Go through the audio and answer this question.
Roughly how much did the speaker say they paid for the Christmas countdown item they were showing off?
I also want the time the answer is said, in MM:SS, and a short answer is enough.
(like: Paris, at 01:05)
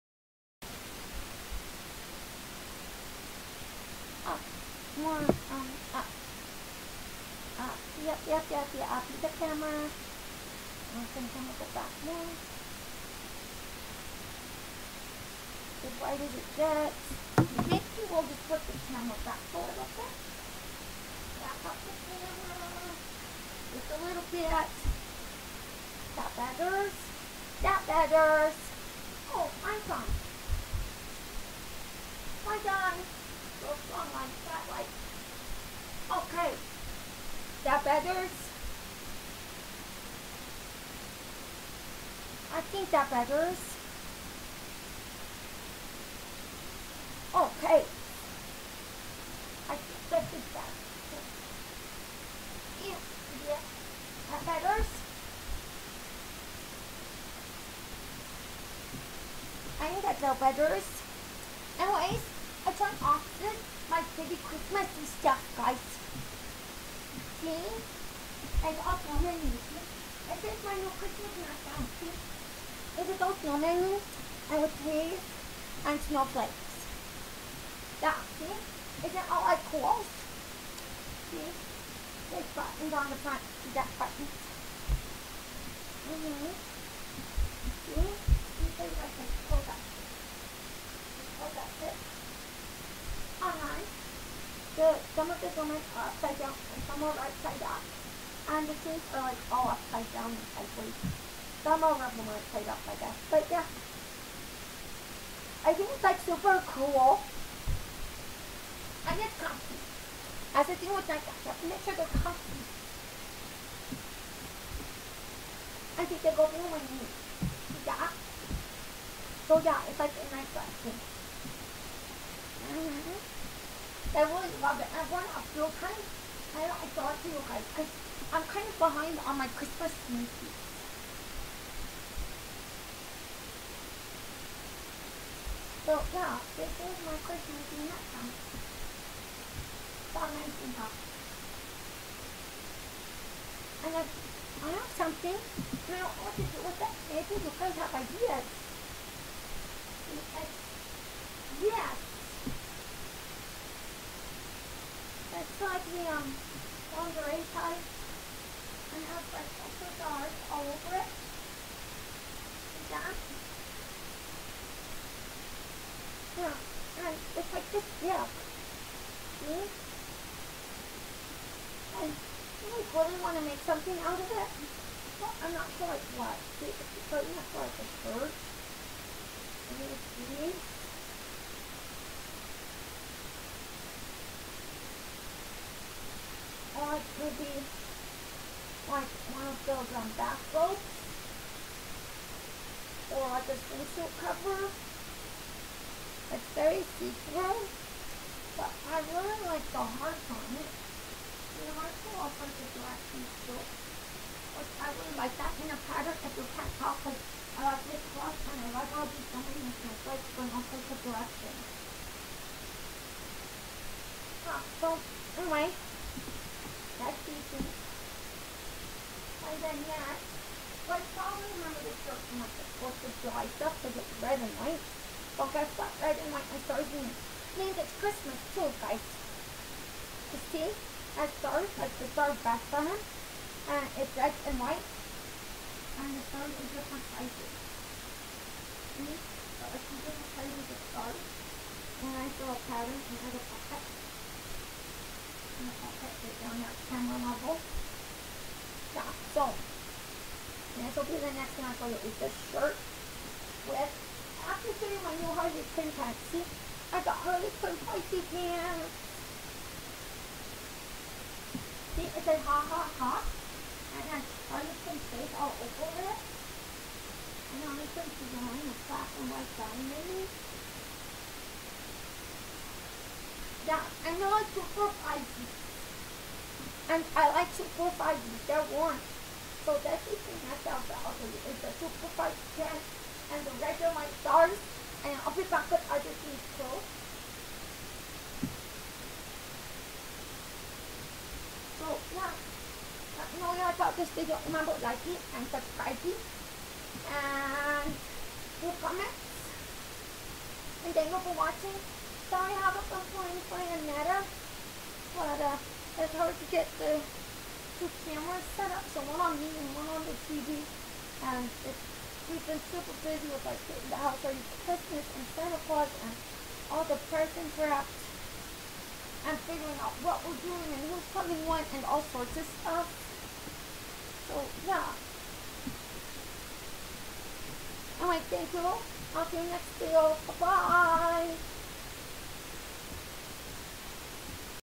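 19 bucks, at 02:20.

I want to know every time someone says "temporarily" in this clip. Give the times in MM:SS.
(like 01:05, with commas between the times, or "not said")
not said.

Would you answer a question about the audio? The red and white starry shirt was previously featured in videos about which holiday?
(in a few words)
4th of July.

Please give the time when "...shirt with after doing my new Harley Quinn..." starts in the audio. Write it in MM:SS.
04:12.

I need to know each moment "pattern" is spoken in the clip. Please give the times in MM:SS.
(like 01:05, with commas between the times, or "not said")
03:25, 04:02.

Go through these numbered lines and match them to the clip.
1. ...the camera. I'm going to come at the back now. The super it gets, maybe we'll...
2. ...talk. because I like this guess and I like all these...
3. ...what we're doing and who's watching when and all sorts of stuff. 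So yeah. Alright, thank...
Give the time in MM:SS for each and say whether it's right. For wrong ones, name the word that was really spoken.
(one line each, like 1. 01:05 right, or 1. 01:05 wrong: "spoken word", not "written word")
1. 00:09 wrong: "wider", not "super"
2. 03:26 wrong: "cross", not "guess"
3. 05:20 wrong: "coming", not "watching".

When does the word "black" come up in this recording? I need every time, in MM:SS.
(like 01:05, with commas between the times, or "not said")
03:22, 04:28.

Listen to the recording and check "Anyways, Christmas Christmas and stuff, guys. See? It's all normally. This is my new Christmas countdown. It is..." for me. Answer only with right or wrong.
wrong.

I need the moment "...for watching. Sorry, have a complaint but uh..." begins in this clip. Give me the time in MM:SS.
05:01.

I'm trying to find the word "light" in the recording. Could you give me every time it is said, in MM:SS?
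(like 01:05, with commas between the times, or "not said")
04:43.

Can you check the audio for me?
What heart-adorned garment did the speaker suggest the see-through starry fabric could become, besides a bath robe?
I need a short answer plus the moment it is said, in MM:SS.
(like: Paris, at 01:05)
swimsuit cover, at 03:13.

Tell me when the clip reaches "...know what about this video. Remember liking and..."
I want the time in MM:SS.
04:53.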